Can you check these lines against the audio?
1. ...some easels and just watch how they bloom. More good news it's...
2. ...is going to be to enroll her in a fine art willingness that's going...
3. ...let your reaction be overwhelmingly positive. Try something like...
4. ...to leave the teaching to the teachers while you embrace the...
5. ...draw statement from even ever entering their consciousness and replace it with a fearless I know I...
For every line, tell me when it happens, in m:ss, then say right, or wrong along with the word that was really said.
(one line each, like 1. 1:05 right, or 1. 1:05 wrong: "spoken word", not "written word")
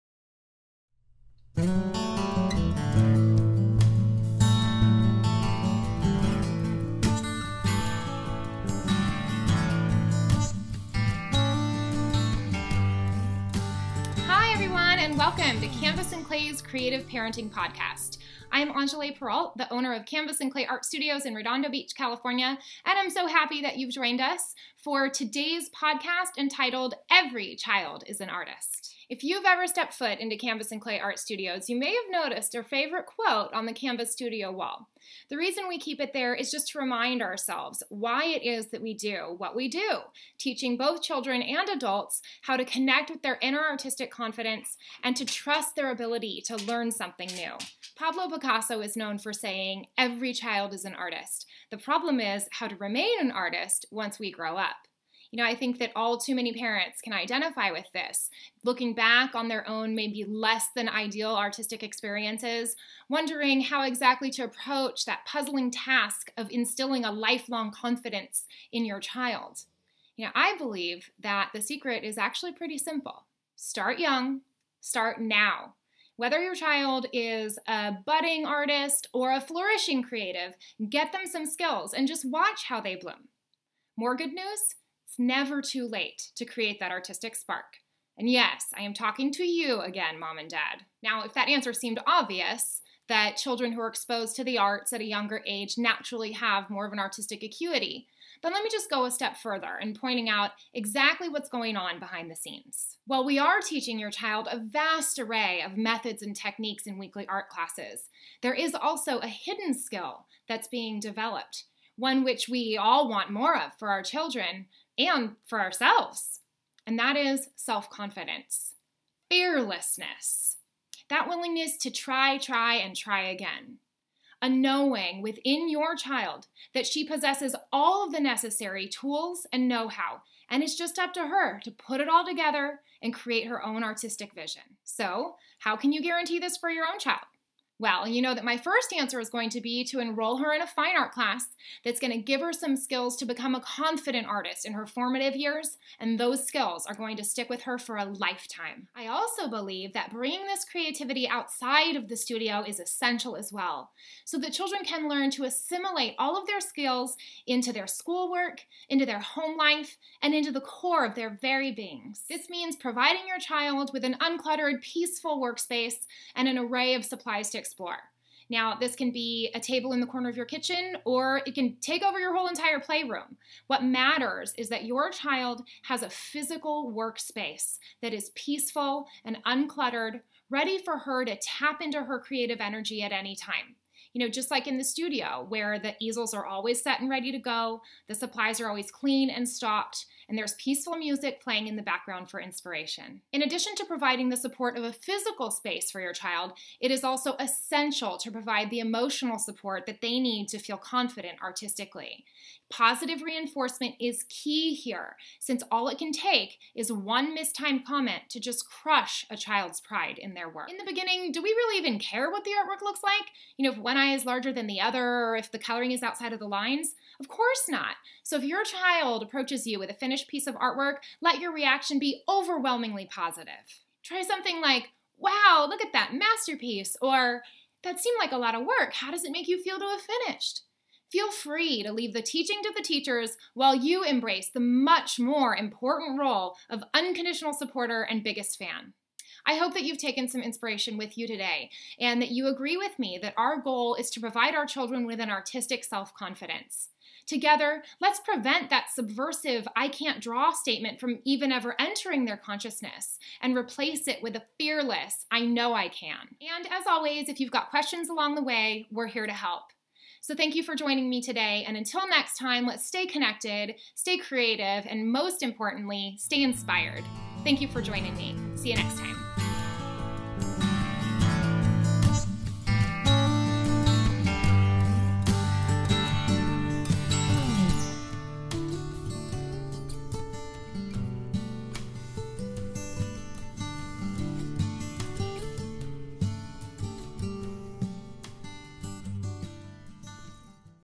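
1. 1:21 wrong: "skills", not "easels"
2. 2:19 wrong: "class", not "willingness"
3. 3:41 right
4. 3:51 right
5. 4:10 right.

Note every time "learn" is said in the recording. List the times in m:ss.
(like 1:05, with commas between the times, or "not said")
0:46, 2:35.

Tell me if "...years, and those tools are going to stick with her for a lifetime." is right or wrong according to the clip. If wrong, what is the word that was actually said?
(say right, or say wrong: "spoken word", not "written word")
wrong: "skills", not "tools".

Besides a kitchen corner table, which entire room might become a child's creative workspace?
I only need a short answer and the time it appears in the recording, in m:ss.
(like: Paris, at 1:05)
playroom, at 2:52.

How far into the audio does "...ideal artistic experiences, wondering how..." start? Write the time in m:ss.
1:00.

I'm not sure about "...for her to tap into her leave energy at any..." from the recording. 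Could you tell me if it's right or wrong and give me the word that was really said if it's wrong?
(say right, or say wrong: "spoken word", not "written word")
wrong: "creative", not "leave".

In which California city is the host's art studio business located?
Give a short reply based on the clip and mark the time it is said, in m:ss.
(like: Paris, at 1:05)
Redondo Beach, at 0:21.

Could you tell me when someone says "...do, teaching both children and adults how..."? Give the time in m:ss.
0:39.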